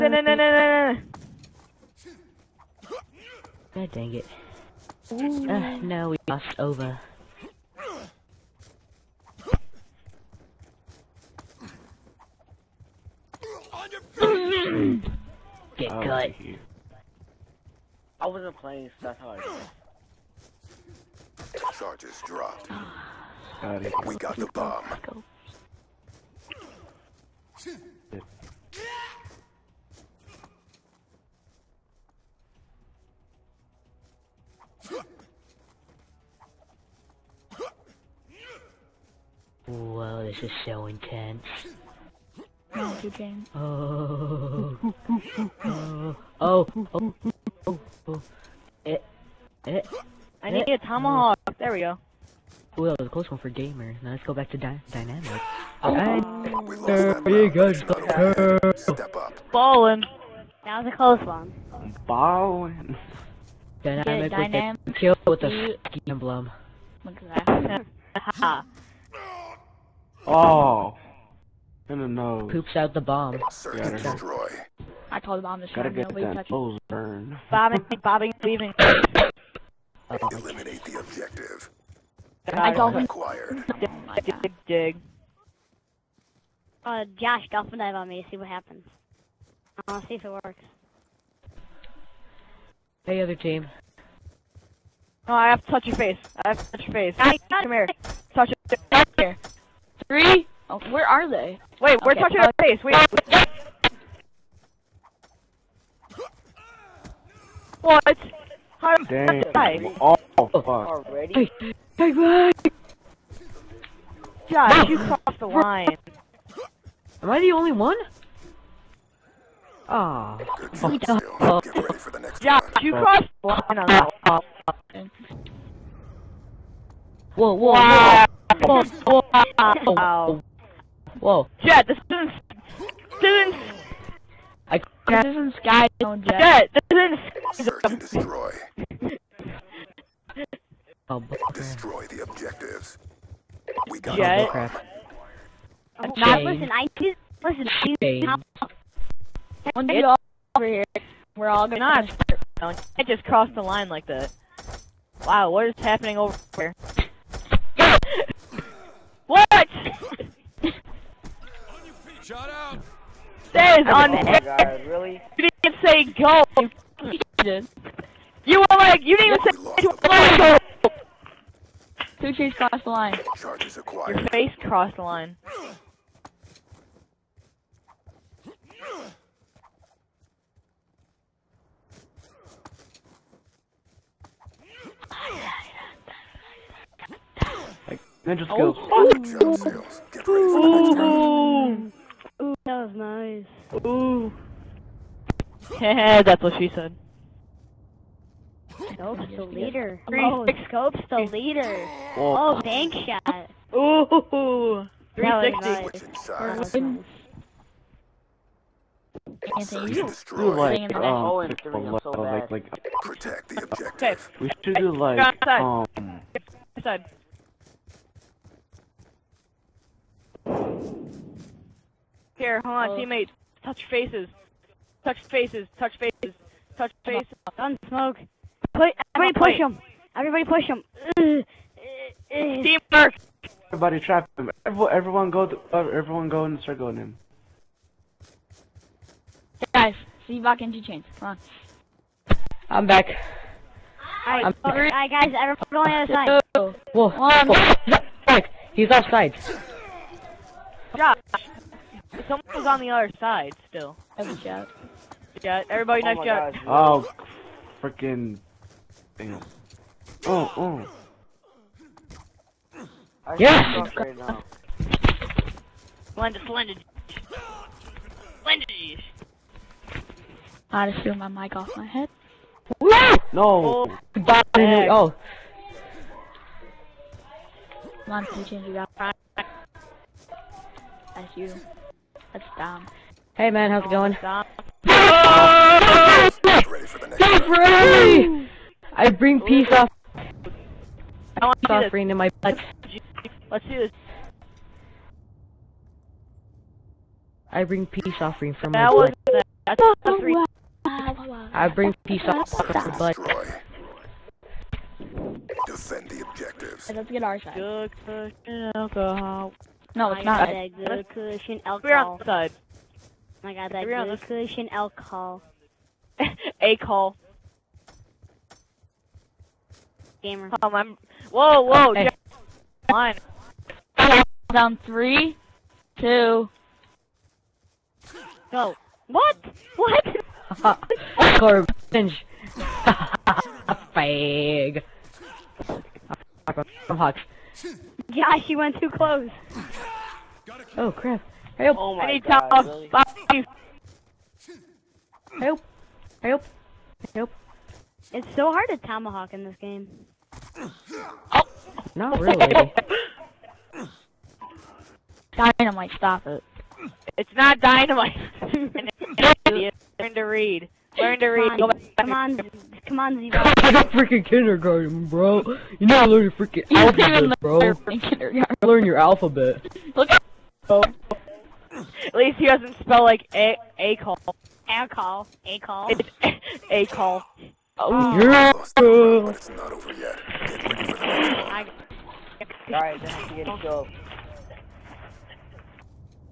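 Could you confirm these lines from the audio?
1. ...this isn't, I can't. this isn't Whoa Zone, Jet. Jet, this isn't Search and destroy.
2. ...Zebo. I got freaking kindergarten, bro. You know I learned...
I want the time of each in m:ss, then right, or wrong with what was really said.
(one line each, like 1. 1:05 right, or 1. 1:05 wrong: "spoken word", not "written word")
1. 2:13 wrong: "Sky", not "Whoa"
2. 6:03 right.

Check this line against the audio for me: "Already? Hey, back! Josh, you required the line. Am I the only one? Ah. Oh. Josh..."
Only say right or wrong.
wrong.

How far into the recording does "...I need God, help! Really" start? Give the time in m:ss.
5:41.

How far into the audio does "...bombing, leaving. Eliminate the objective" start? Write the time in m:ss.
1:18.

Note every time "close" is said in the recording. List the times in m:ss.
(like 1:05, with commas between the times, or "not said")
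0:53, 1:00, 5:38.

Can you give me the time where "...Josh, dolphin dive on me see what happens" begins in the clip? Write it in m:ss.
1:27.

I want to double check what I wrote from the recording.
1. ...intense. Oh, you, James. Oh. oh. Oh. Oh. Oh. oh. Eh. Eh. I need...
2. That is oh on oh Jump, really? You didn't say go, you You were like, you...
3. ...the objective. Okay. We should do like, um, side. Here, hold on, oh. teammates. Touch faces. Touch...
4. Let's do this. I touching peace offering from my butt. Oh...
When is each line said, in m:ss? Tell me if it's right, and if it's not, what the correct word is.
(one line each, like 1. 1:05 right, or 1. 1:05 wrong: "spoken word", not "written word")
1. 0:40 right
2. 2:43 wrong: "God", not "Jump"
3. 3:33 right
4. 4:53 wrong: "bring", not "touching".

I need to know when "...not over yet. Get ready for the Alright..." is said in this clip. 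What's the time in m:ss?
6:19.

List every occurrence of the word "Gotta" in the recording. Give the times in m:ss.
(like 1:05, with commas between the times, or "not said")
1:15.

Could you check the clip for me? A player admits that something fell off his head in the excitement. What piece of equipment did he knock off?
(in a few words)
mic.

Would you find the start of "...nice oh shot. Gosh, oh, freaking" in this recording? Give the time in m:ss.
4:16.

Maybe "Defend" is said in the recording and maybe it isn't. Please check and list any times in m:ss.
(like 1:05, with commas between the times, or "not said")
5:05.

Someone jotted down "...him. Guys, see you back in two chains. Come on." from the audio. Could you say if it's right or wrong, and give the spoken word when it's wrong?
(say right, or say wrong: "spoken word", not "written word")
right.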